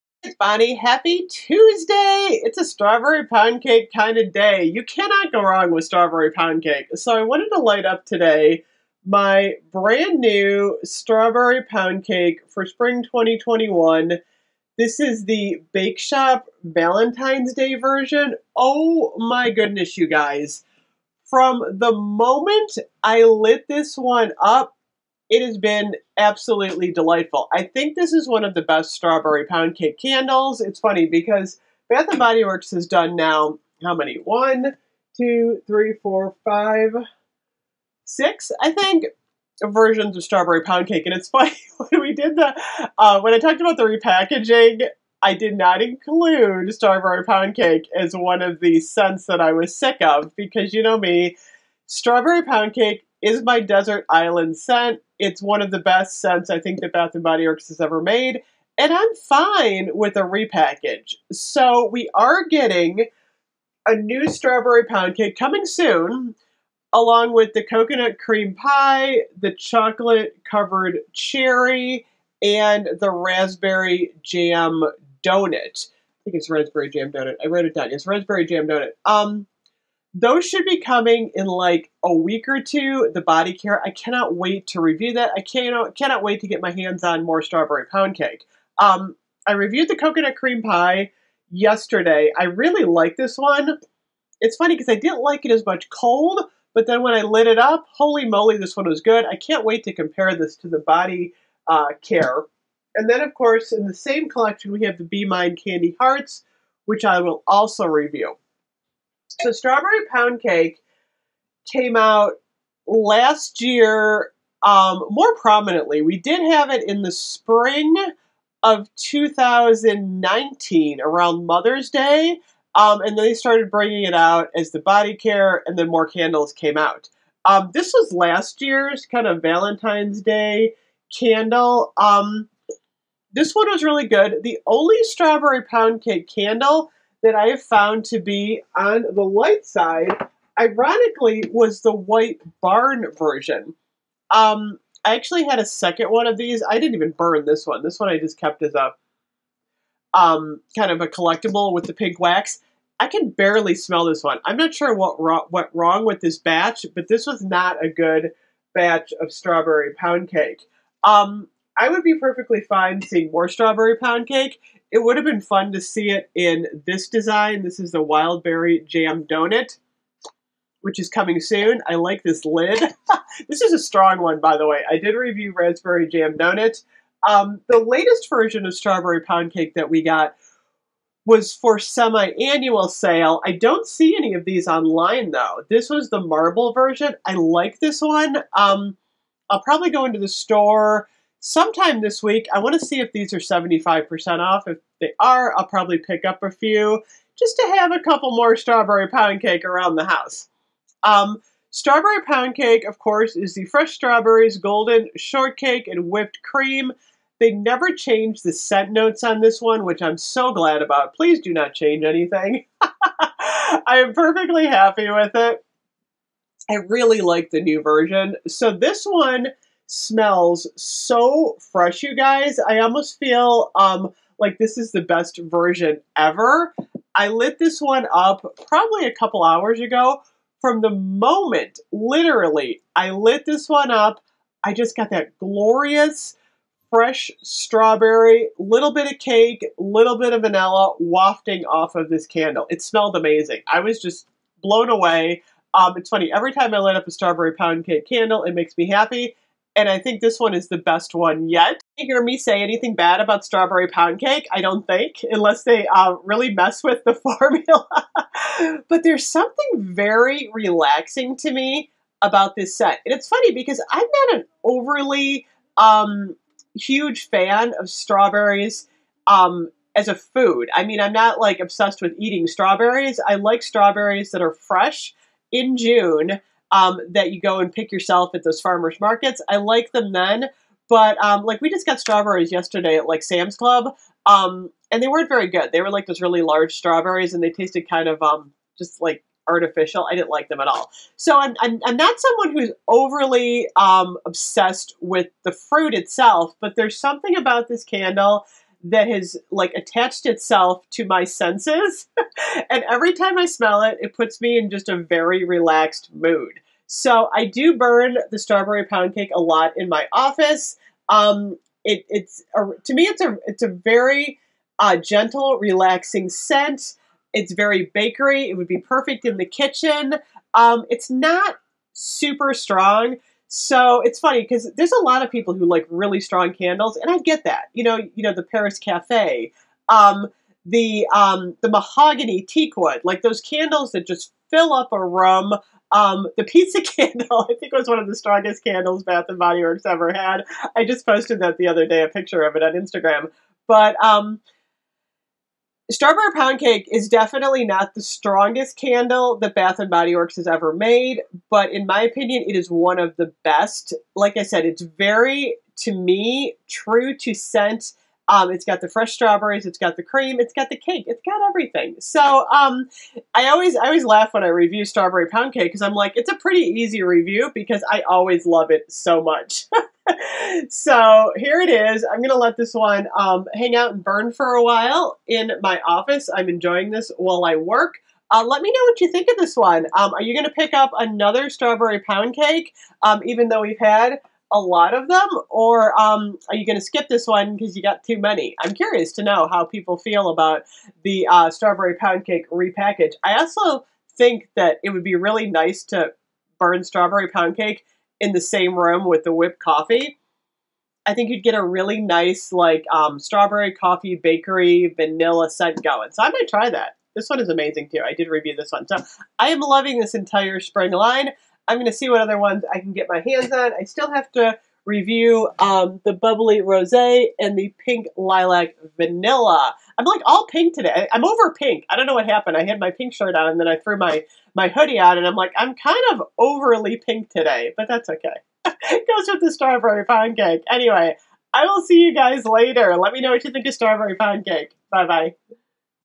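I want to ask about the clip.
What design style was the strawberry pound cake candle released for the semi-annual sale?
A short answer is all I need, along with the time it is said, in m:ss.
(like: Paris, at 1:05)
Marble, at 3:06.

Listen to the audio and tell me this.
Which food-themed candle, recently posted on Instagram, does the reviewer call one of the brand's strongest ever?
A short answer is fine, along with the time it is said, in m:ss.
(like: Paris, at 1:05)
Pizza, at 5:36.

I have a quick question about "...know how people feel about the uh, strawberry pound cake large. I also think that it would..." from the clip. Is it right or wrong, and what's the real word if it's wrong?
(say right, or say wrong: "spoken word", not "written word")
wrong: "repackage", not "large".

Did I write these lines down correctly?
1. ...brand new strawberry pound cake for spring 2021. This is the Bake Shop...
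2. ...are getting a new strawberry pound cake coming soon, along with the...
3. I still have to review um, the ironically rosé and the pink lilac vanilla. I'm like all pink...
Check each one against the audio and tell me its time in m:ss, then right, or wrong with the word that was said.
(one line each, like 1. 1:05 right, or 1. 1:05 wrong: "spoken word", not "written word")
1. 0:09 right
2. 1:02 right
3. 6:53 wrong: "bubbly", not "ironically".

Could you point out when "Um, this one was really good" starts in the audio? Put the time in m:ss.
2:11.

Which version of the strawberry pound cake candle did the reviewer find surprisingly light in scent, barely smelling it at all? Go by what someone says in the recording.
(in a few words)
White Barn.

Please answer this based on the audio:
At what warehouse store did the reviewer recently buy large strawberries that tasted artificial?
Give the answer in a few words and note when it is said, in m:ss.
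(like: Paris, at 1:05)
Sam's Club, at 4:43.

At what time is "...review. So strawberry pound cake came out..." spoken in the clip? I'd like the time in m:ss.
1:47.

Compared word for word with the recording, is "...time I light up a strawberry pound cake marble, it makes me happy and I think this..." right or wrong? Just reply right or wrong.
wrong.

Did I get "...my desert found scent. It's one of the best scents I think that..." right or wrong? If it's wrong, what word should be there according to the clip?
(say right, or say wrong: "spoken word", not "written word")
wrong: "island", not "found".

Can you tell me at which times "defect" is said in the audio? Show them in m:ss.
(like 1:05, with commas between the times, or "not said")
not said.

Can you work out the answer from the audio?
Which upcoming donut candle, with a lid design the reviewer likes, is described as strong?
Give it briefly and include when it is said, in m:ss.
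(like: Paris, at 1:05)
Wildberry Jam Donut, at 2:48.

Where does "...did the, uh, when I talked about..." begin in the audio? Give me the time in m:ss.
0:42.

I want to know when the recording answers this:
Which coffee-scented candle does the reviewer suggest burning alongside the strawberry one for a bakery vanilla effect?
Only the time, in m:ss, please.
6:39.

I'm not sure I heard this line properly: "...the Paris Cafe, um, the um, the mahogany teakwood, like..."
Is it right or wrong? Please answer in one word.
right.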